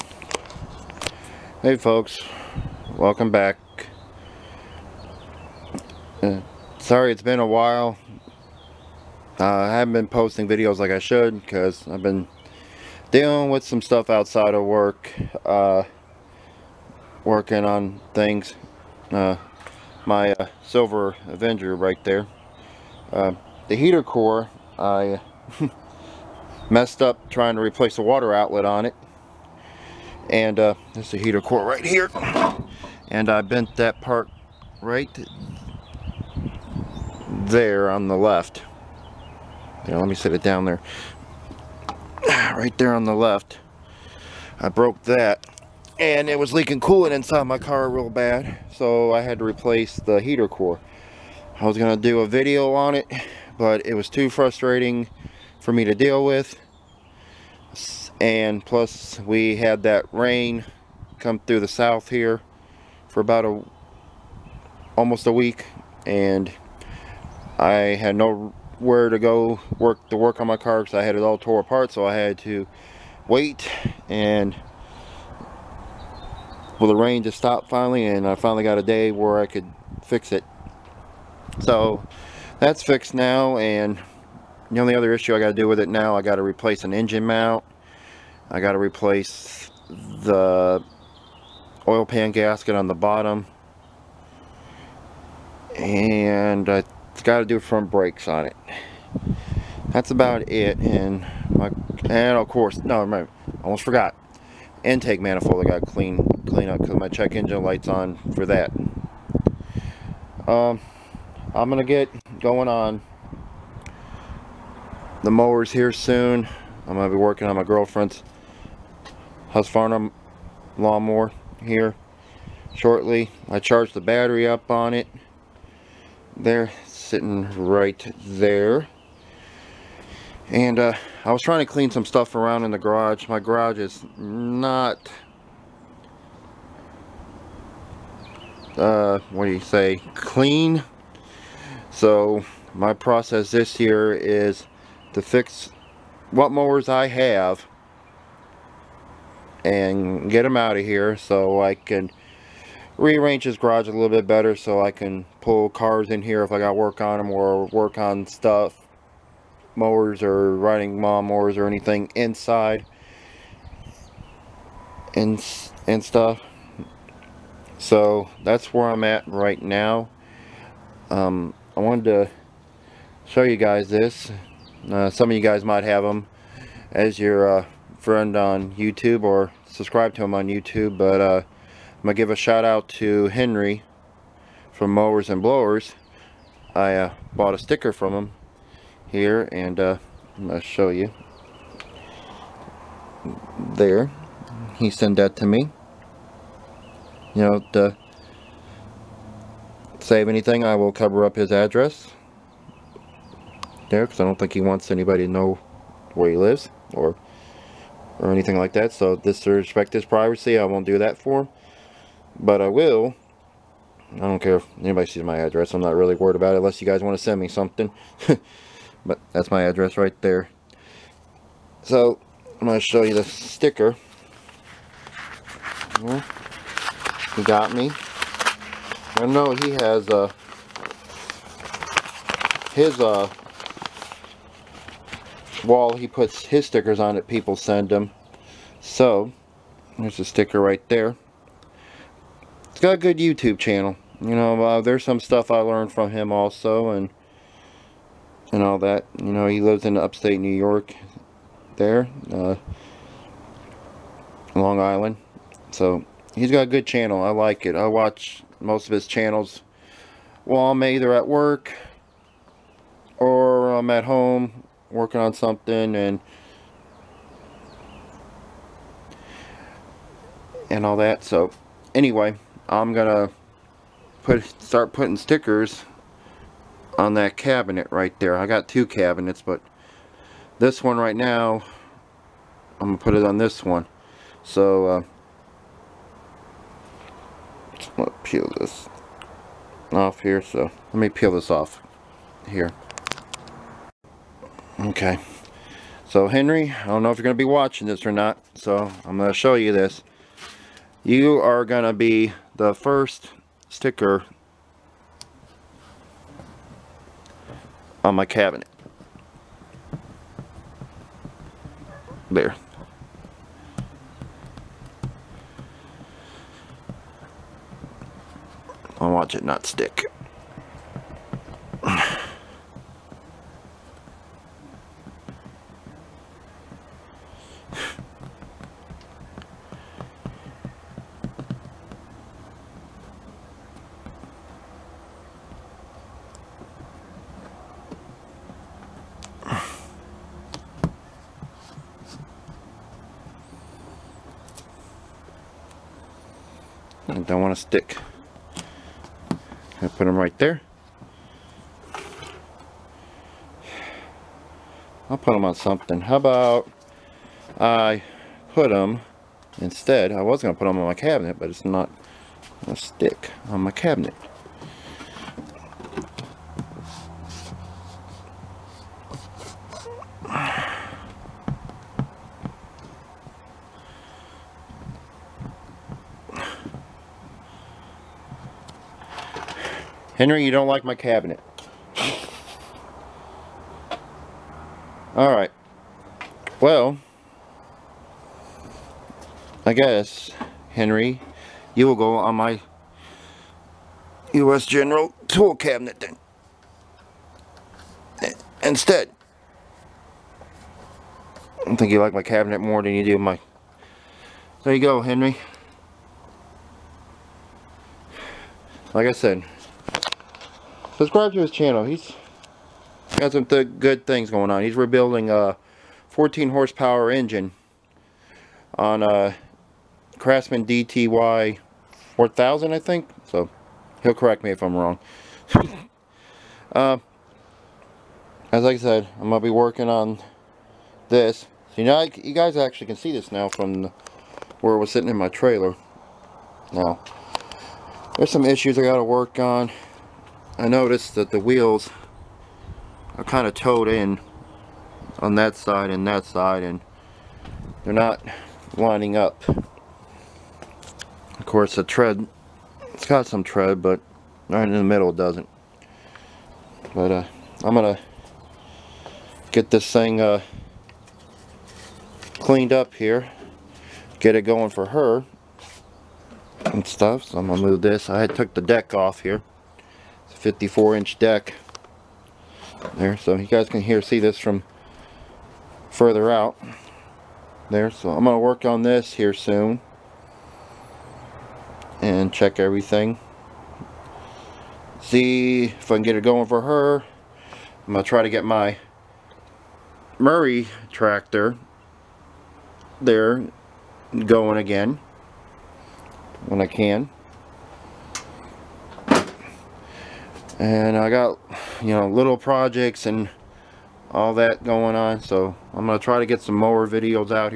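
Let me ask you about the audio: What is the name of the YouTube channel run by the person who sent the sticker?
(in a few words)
Mowers and Blowers.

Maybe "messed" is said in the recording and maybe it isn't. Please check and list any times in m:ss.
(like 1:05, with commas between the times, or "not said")
0:26.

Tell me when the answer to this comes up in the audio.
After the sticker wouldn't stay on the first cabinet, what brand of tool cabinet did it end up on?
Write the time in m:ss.
6:34.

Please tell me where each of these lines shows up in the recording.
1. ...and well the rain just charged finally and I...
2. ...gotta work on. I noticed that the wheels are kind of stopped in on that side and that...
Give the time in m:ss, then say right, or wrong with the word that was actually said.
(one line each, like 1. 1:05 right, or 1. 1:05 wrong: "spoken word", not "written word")
1. 1:14 wrong: "stopped", not "charged"
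2. 7:18 wrong: "towed", not "stopped".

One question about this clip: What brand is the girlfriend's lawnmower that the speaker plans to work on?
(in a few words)
Husqvarna.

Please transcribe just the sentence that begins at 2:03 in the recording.
I charged the battery up on it.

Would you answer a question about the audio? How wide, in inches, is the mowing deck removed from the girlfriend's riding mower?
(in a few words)
54.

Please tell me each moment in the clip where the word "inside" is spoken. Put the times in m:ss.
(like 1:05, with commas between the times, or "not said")
0:47, 2:42.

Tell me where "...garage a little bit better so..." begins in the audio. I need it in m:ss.
2:33.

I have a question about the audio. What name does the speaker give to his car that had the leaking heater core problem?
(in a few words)
Silver Avenger.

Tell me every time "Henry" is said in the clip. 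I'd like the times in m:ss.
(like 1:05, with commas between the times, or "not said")
3:03, 4:56, 6:20, 6:30, 6:45.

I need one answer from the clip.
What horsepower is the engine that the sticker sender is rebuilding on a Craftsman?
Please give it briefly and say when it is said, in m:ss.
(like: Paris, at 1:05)
14, at 6:56.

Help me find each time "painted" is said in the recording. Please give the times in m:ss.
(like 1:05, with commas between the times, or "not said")
not said.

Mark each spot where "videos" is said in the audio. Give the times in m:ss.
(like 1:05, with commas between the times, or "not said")
0:10, 0:52, 8:26.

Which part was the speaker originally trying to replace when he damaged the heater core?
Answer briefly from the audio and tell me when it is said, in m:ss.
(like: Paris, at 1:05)
water outlet, at 0:28.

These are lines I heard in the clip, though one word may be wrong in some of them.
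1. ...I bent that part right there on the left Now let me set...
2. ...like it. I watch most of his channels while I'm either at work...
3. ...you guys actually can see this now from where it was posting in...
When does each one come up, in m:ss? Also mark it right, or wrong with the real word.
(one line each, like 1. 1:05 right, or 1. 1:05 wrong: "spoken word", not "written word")
1. 0:33 right
2. 4:17 right
3. 7:12 wrong: "sitting", not "posting".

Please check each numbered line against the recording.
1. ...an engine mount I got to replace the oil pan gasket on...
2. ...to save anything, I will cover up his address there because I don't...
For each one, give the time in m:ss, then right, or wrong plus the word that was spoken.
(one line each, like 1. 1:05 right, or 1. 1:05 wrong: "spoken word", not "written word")
1. 1:26 right
2. 3:17 right.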